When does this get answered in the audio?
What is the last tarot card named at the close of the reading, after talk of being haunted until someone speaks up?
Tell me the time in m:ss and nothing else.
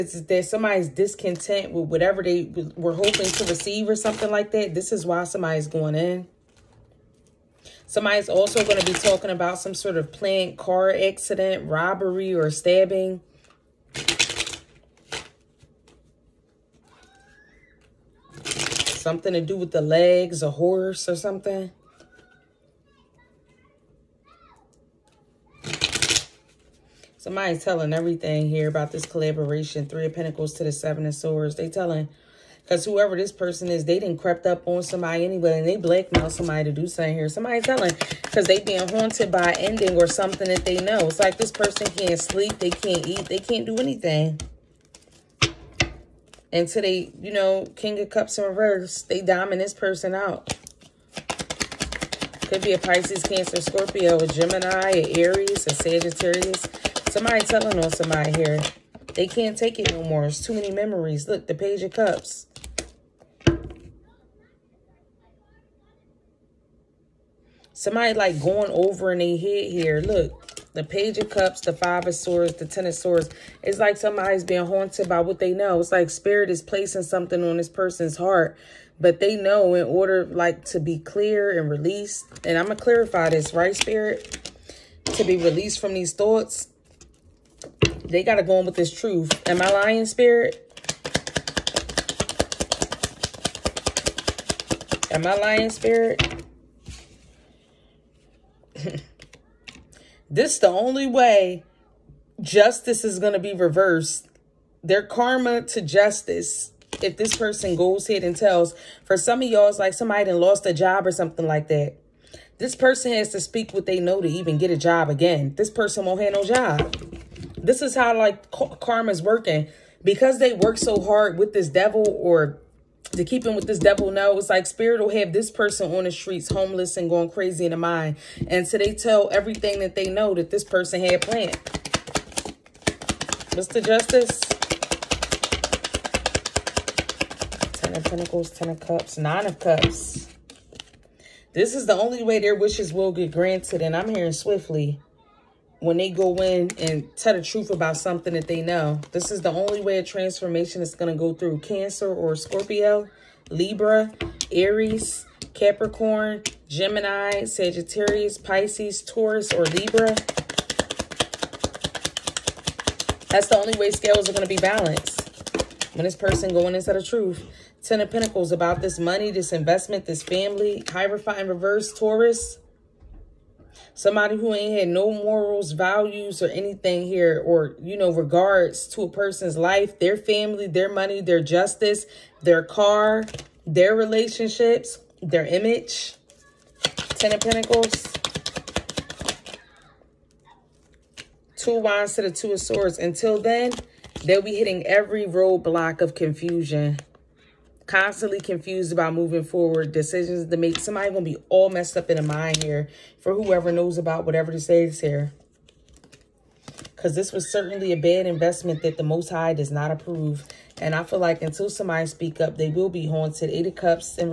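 3:33.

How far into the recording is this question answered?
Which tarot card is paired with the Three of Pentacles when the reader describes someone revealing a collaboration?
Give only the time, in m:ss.
0:30.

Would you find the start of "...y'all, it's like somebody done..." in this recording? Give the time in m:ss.
1:49.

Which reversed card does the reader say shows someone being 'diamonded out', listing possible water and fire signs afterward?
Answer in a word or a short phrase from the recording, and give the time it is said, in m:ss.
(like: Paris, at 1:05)
King of Cups, at 0:47.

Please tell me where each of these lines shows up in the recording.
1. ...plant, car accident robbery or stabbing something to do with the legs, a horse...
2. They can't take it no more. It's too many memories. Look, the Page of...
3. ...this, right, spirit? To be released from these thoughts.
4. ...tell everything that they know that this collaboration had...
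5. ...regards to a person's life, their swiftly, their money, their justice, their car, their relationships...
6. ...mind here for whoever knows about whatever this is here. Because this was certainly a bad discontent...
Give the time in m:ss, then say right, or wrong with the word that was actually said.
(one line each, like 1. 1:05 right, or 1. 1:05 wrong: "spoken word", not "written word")
1. 0:10 right
2. 0:59 right
3. 1:23 right
4. 2:08 wrong: "person", not "collaboration"
5. 2:58 wrong: "family", not "swiftly"
6. 3:22 wrong: "investment", not "discontent".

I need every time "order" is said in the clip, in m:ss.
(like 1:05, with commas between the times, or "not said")
1:19.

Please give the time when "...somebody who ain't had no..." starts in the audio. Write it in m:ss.
2:53.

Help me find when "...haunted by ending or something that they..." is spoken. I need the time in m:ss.
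0:38.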